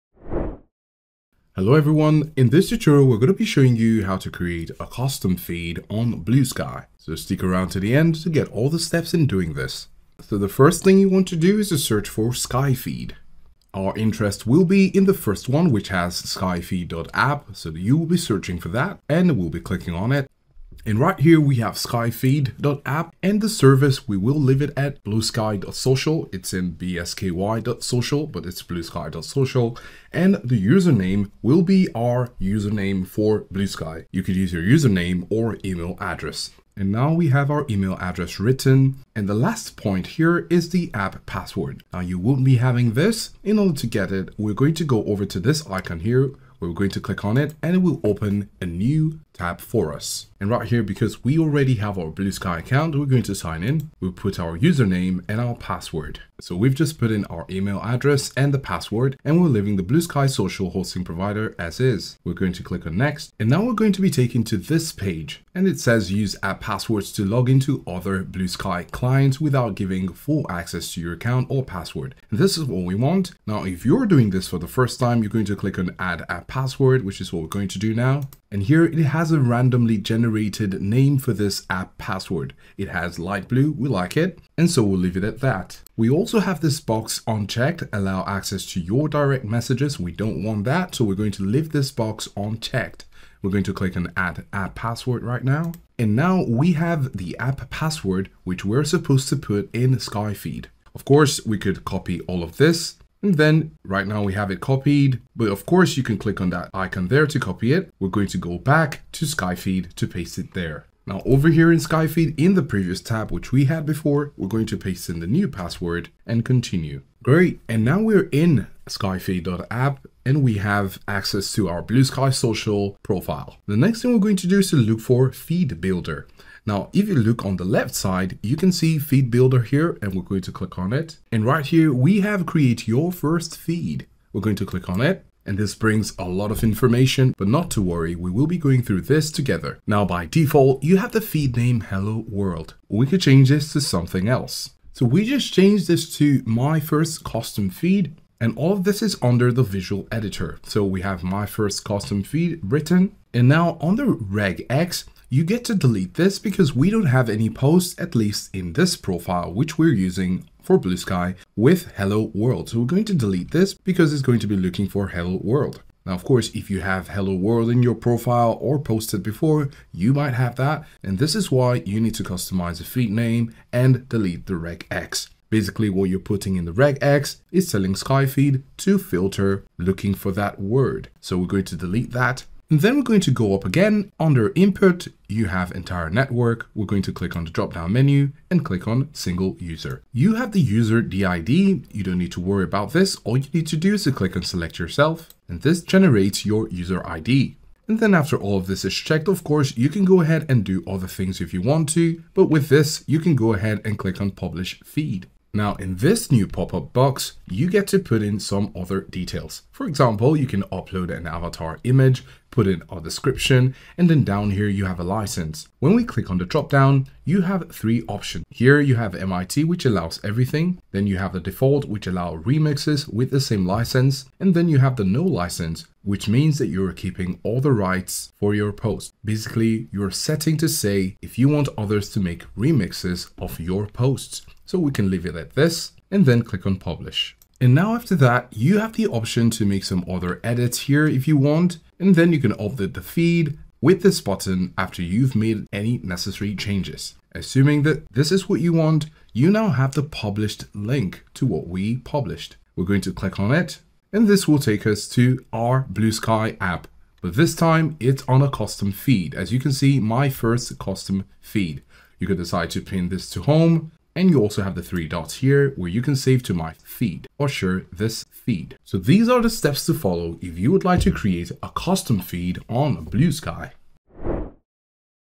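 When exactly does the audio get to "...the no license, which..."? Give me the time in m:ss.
3:44.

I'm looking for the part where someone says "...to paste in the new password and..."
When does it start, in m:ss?
1:54.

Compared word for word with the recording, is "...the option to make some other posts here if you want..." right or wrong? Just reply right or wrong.
wrong.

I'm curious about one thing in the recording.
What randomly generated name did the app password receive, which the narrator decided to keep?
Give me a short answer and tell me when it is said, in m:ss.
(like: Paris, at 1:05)
light blue, at 1:23.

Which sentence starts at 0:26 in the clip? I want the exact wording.
It's in bsky.social, but it's bluesky.social.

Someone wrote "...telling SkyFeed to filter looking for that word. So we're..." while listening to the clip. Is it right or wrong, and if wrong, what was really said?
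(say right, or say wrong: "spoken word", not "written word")
right.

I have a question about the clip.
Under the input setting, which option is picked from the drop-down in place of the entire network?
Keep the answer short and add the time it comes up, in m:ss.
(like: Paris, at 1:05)
single user, at 3:09.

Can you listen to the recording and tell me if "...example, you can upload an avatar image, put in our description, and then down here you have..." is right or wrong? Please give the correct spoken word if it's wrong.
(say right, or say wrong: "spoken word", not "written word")
right.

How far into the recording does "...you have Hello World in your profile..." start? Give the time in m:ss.
2:46.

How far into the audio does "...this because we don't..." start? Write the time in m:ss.
2:36.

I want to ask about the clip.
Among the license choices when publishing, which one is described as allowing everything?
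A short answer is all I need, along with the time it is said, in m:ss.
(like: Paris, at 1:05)
MIT, at 3:39.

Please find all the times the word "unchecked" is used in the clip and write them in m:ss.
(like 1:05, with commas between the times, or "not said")
1:27, 1:32.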